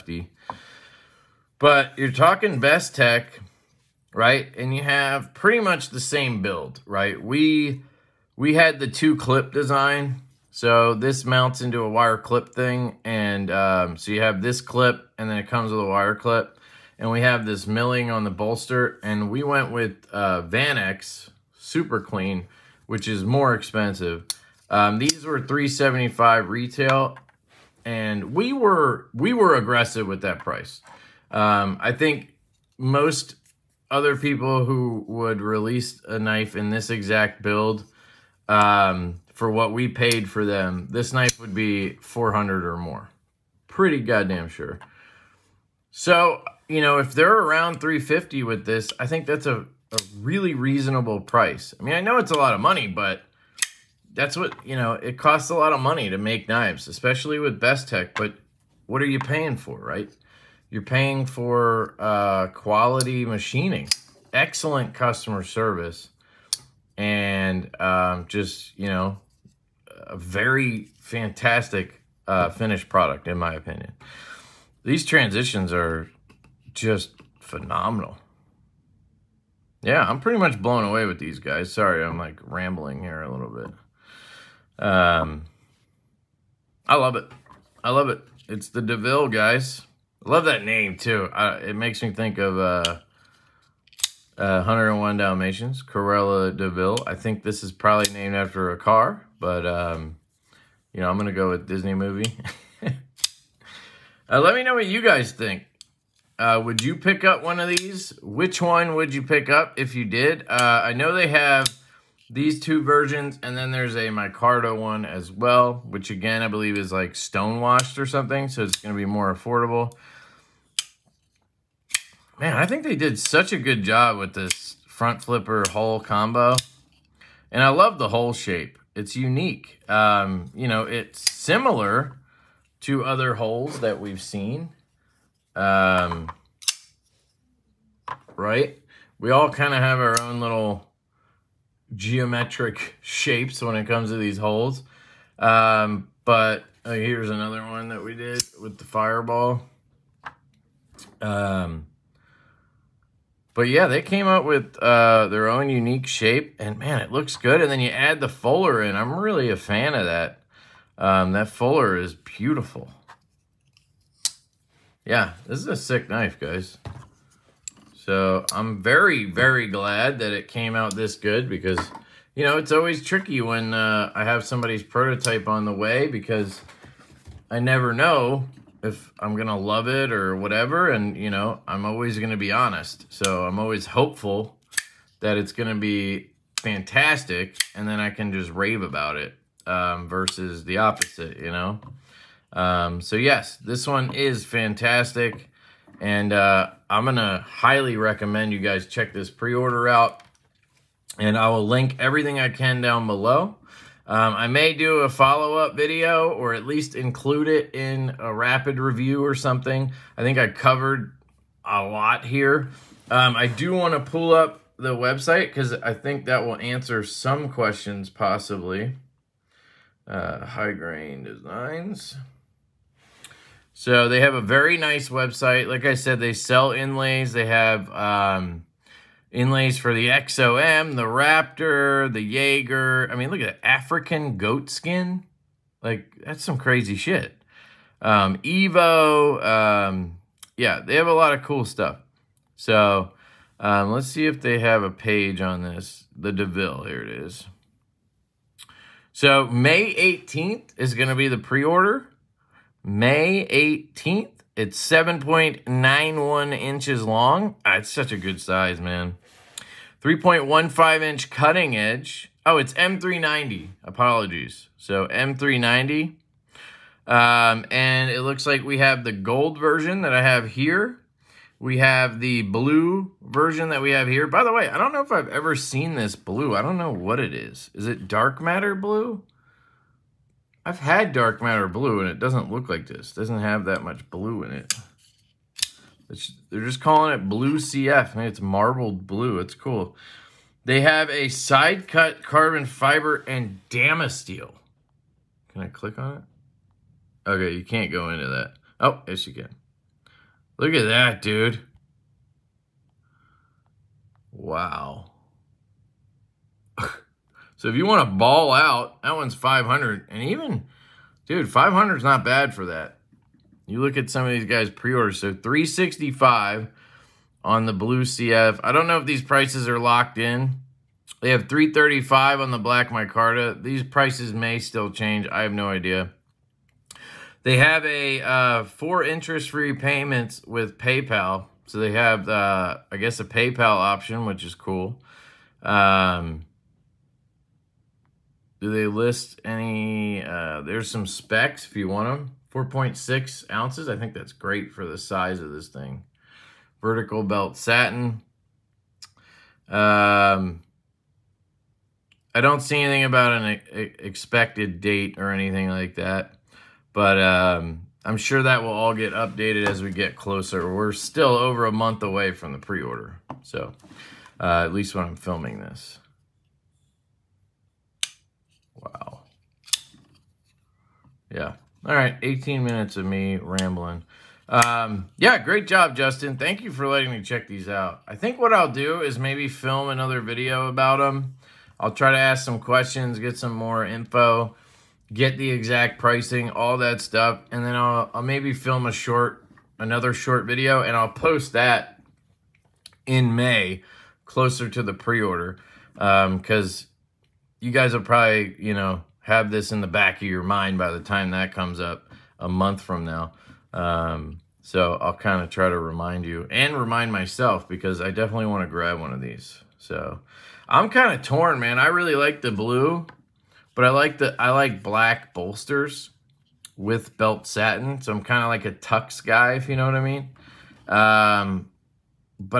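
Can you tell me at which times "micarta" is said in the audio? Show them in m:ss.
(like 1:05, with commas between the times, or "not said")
1:54, 5:22.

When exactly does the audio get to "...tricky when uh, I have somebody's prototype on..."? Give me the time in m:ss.
2:53.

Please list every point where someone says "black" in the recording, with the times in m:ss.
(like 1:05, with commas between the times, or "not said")
5:22, 6:54.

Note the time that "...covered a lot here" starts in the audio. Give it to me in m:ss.
3:30.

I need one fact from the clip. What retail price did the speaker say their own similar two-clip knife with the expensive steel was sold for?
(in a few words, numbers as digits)
375.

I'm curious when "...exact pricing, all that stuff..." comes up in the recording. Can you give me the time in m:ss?
6:25.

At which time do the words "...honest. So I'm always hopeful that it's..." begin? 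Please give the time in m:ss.
3:02.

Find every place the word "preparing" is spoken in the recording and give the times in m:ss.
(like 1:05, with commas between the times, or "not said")
not said.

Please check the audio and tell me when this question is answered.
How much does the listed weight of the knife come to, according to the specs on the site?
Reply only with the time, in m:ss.
5:42.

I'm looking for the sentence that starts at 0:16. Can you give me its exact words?
And we have this milling on the bolster.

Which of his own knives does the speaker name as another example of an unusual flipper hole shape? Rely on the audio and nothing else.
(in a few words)
the fireball.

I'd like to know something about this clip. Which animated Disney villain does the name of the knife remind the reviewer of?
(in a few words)
Cruella DeVille.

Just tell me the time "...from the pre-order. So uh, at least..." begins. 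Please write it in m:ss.
6:02.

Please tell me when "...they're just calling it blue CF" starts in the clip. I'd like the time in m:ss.
4:46.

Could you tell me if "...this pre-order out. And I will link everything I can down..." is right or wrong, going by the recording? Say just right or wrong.
right.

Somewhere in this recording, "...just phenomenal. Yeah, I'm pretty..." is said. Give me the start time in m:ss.
1:16.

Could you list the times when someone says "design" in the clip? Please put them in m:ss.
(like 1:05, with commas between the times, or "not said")
0:09, 3:41.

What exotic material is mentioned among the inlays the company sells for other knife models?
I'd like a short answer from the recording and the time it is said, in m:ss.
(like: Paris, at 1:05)
African goat skin, at 3:53.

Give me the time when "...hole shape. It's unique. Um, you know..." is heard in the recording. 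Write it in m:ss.
2:08.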